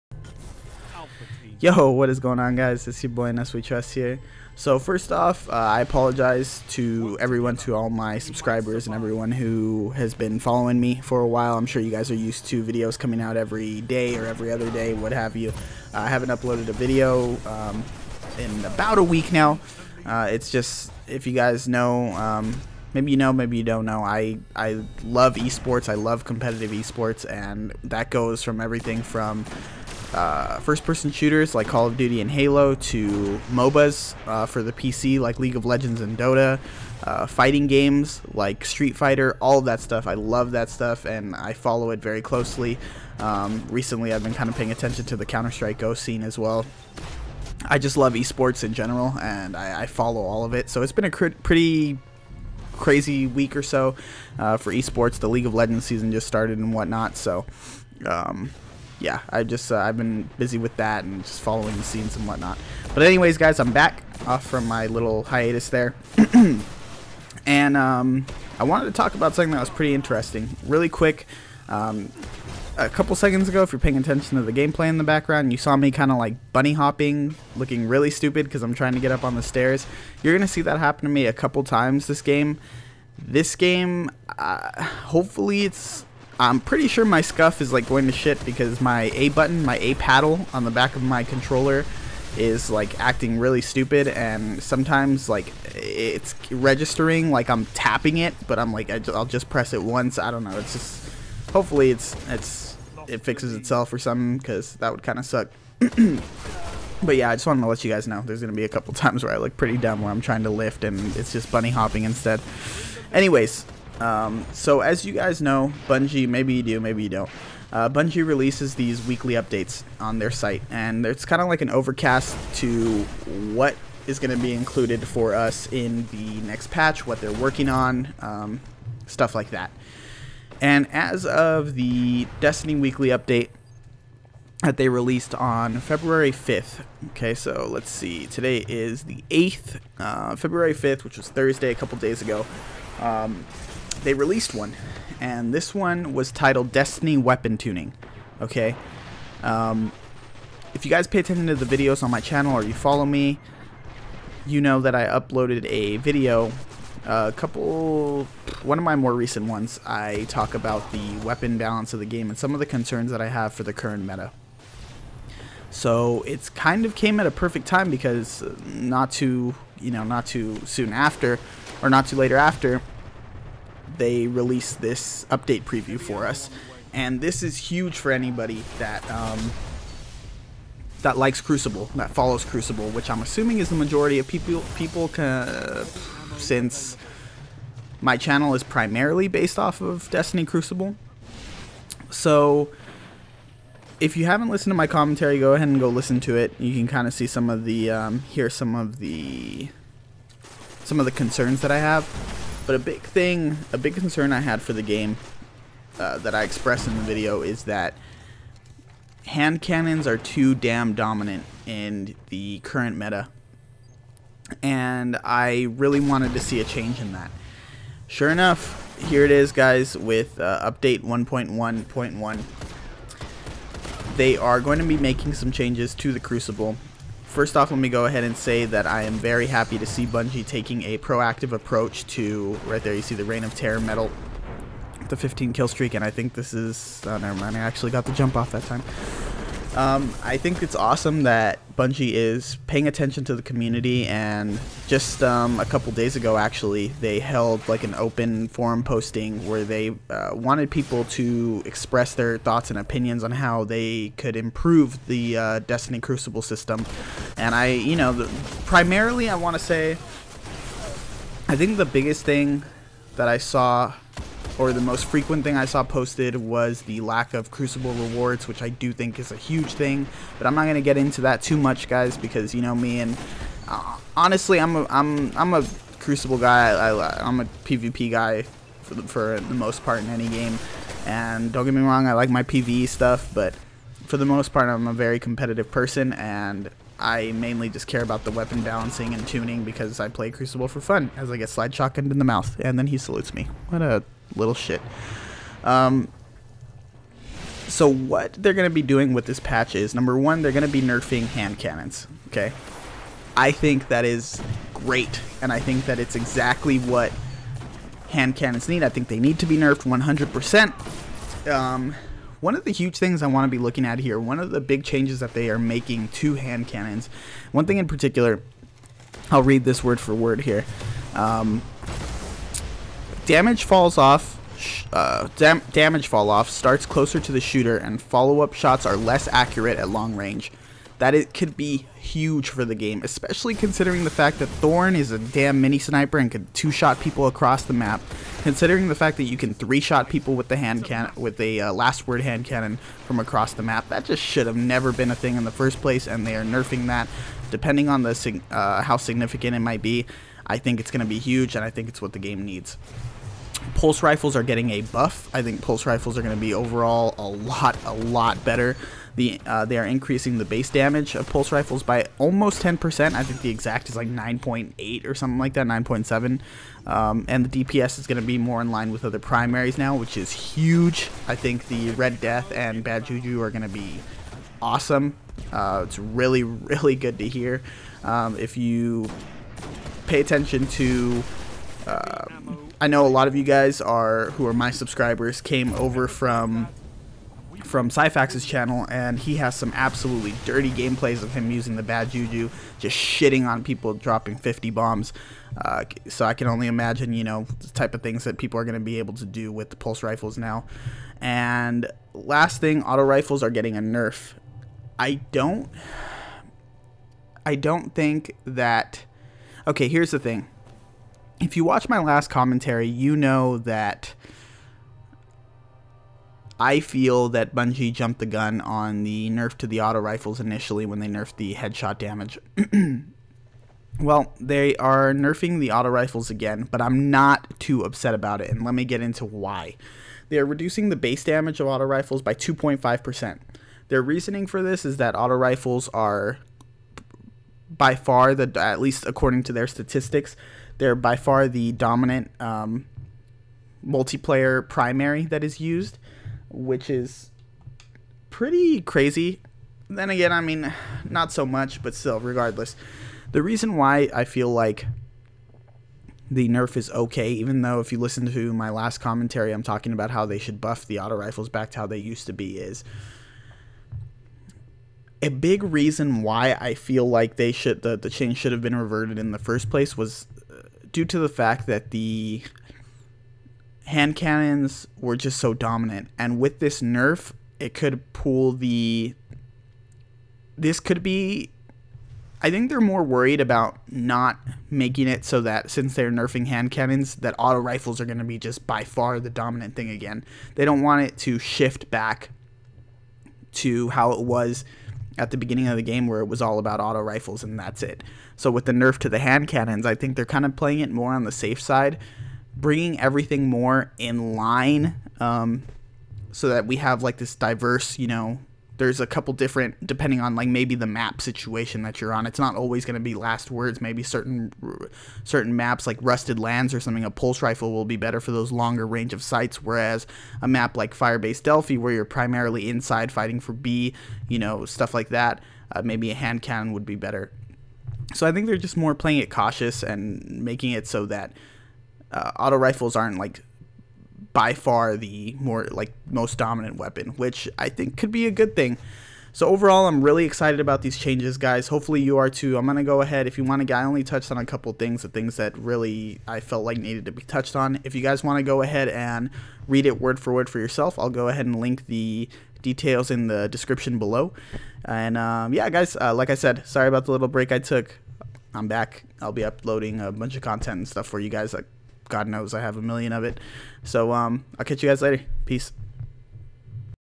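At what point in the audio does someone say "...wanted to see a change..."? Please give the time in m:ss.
3:35.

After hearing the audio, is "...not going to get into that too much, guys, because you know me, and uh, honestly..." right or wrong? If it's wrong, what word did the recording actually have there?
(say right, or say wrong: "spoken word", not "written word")
right.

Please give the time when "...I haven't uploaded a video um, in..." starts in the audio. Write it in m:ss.
0:15.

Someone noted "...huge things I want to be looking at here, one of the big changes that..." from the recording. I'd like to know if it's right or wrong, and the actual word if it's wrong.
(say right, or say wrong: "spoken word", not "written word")
right.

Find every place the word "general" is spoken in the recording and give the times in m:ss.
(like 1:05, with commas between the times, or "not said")
0:48.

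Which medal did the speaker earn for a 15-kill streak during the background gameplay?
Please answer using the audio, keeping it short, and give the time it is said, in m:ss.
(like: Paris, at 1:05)
Reign of Terror, at 3:53.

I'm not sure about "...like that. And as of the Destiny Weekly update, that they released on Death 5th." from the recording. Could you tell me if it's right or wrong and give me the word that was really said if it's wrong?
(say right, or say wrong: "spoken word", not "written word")
wrong: "February", not "Death".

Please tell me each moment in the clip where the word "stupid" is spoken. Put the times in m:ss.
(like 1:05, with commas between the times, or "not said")
1:18, 1:33.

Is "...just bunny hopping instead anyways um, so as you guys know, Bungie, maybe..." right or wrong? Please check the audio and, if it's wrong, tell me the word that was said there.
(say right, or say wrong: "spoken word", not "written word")
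right.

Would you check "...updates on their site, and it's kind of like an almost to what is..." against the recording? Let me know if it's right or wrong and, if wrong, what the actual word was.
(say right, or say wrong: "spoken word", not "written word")
wrong: "overcast", not "almost".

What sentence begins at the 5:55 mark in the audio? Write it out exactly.
I think pulse rifles are going to be overall a lot, a lot better.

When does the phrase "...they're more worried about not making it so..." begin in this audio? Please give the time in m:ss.
8:02.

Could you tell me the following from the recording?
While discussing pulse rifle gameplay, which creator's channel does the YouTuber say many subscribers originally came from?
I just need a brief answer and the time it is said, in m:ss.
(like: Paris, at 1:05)
Syfax, at 6:27.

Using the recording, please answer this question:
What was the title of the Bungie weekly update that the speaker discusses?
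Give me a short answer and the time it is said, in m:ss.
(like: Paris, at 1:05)
Destiny Weapon Tuning, at 2:26.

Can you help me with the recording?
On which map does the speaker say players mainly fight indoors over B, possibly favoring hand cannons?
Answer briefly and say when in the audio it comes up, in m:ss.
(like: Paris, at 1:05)
Firebase Delphi, at 8:40.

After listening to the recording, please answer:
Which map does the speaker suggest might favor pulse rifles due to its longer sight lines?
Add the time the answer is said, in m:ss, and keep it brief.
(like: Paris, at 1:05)
Rusted Lands, at 8:36.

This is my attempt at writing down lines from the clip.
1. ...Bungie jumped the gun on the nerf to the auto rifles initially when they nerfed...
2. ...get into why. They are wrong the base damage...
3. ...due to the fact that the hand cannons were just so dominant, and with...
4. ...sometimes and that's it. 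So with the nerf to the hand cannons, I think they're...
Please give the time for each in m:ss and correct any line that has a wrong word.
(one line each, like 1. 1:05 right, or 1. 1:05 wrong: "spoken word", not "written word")
1. 6:57 right
2. 7:08 wrong: "reducing", not "wrong"
3. 7:50 right
4. 8:16 wrong: "rifles", not "sometimes".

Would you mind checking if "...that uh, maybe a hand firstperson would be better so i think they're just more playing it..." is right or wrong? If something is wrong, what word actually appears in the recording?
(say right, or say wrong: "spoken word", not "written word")
wrong: "cannon", not "firstperson".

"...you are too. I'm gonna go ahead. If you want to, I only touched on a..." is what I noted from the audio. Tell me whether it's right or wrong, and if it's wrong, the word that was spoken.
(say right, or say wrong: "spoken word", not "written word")
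right.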